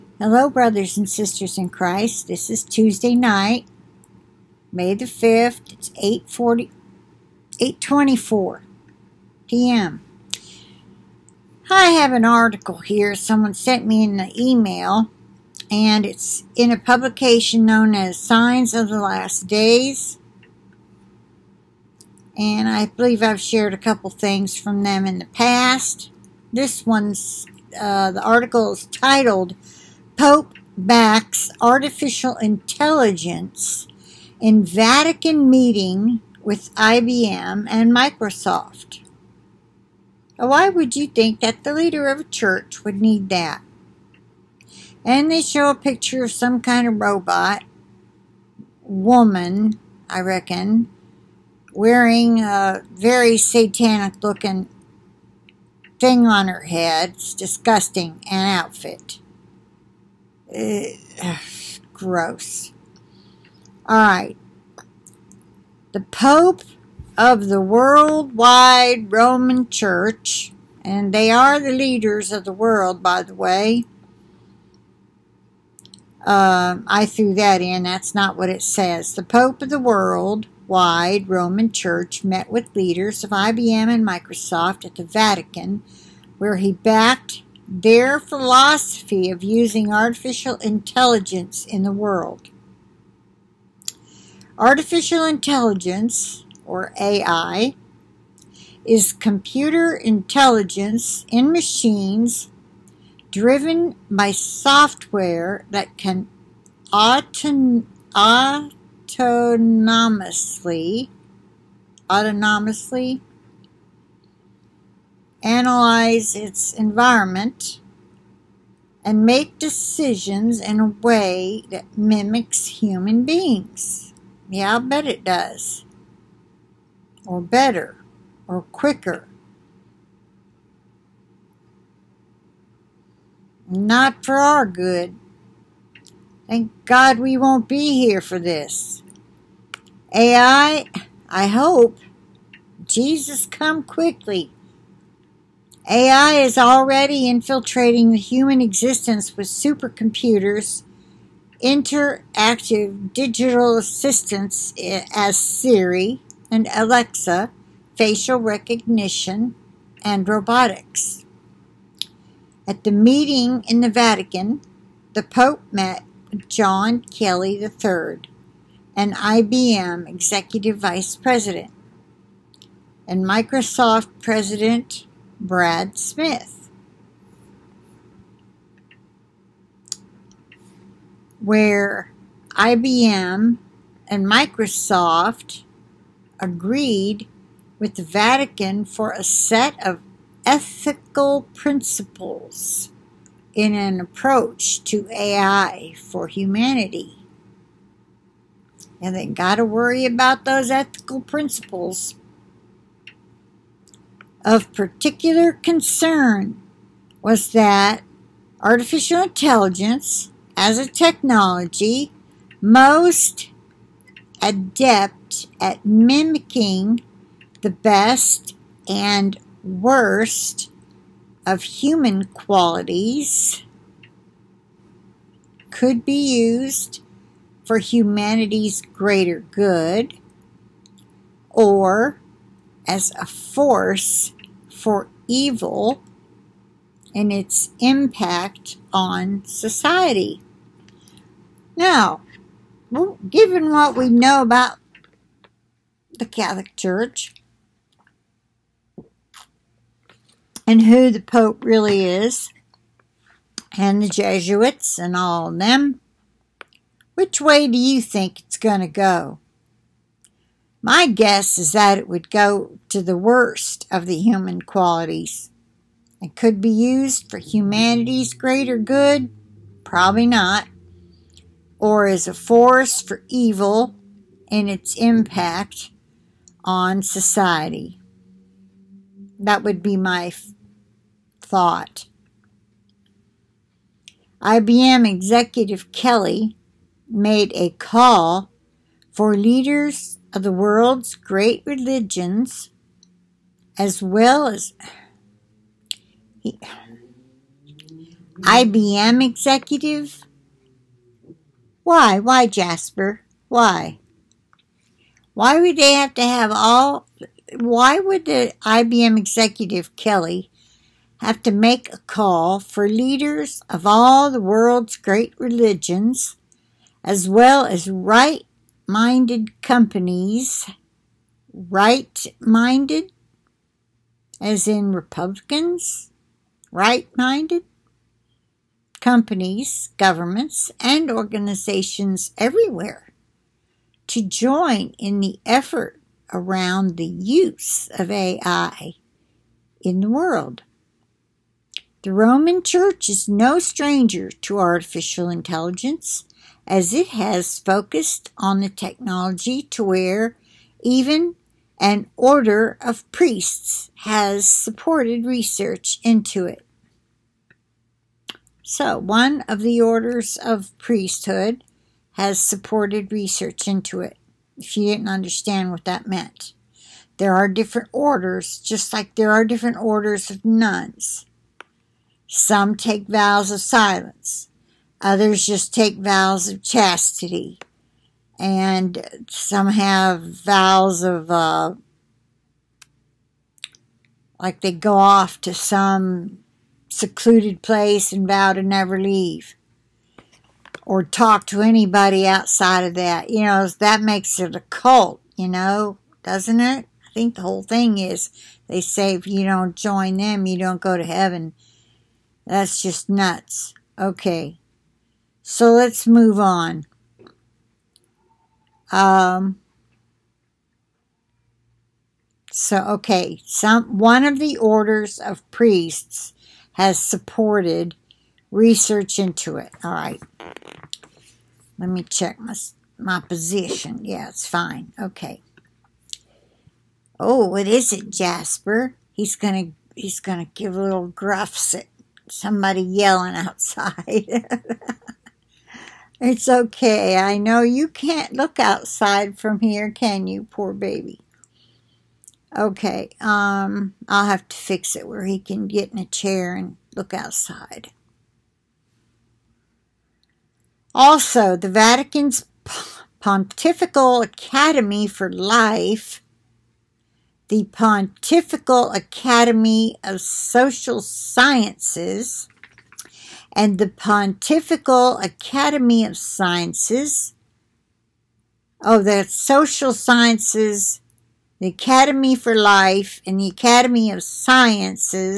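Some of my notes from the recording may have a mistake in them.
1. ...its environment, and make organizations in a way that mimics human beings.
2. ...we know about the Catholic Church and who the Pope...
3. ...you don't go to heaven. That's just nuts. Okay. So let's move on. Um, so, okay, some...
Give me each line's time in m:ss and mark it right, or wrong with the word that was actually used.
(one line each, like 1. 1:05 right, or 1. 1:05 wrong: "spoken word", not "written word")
1. 1:56 wrong: "decisions", not "organizations"
2. 4:03 right
3. 6:40 right.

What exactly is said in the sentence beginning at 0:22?
And I believe I've shared a couple things from them in the past.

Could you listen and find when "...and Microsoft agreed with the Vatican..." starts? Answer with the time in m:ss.
3:04.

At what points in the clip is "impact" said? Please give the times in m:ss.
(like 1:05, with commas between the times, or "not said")
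3:57, 4:34.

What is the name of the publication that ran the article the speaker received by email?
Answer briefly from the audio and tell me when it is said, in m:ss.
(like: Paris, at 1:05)
Signs of the Last Days, at 0:18.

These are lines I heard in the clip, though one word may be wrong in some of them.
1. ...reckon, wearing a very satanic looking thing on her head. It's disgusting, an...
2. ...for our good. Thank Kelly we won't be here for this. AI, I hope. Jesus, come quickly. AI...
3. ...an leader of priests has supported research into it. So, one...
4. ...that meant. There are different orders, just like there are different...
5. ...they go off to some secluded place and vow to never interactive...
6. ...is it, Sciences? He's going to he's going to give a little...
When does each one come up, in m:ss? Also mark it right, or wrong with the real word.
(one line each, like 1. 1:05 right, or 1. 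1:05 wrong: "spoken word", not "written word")
1. 0:50 right
2. 2:14 wrong: "God", not "Kelly"
3. 5:51 wrong: "order", not "leader"
4. 6:05 right
5. 6:24 wrong: "leave", not "interactive"
6. 7:07 wrong: "Jasper", not "Sciences".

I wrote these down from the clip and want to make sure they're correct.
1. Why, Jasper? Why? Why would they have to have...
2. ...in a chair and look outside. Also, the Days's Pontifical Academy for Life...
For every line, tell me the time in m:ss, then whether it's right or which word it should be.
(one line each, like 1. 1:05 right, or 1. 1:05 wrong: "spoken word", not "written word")
1. 5:02 right
2. 7:25 wrong: "Vatican", not "Days".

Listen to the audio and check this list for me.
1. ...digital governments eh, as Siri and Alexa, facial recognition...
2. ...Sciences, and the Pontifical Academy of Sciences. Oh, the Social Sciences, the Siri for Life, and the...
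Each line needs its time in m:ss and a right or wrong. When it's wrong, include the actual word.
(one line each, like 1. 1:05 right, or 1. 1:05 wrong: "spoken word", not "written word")
1. 2:33 wrong: "assistants", not "governments"
2. 7:41 wrong: "Academy", not "Siri".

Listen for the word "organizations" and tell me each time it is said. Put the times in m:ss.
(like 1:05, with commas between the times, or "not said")
5:31.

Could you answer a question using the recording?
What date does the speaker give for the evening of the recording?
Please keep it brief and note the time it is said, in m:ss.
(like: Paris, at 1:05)
May 5th, at 0:04.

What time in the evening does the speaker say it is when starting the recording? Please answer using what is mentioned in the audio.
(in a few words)
8:24 p.m.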